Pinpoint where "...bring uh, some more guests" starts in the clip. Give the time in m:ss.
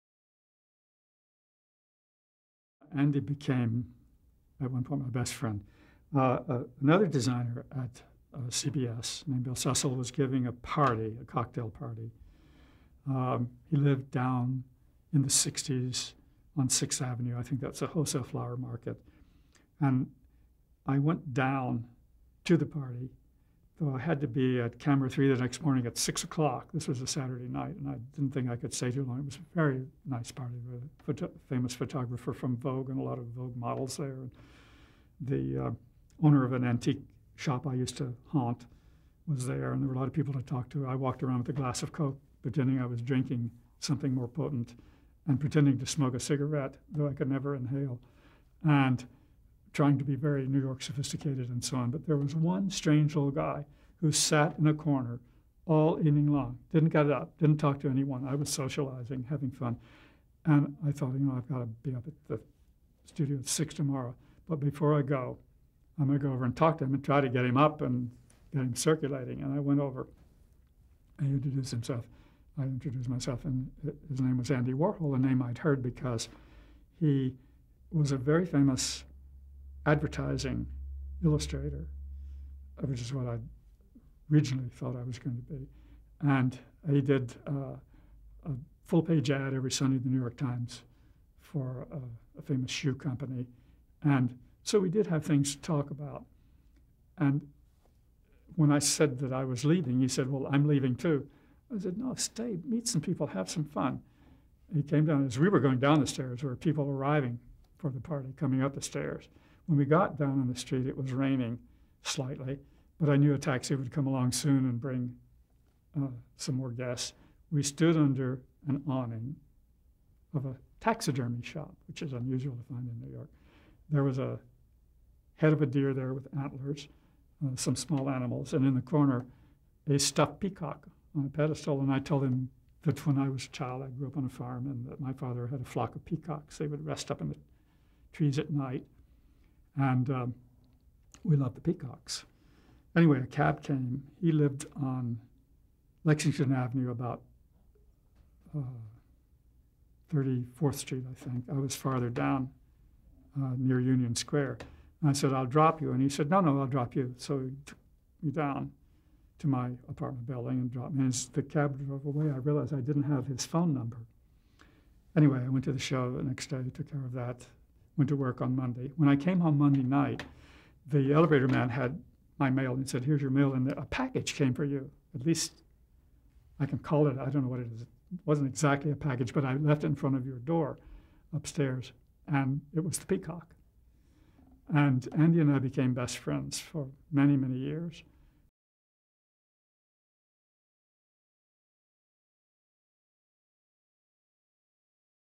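1:54.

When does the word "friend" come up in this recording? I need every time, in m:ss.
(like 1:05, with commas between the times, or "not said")
0:05, 3:06.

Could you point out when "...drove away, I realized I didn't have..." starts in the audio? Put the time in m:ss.
2:41.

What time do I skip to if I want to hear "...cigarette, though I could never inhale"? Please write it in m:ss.
0:46.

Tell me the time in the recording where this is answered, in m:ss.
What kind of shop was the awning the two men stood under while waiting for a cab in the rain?
2:00.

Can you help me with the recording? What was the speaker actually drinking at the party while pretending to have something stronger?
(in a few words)
Coke.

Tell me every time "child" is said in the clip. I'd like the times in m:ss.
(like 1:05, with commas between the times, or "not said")
2:13.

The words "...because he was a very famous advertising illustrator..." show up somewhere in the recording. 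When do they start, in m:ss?
1:15.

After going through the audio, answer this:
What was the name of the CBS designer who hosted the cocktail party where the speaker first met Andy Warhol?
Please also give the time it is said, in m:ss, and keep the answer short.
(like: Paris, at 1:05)
Bill Cecil, at 0:09.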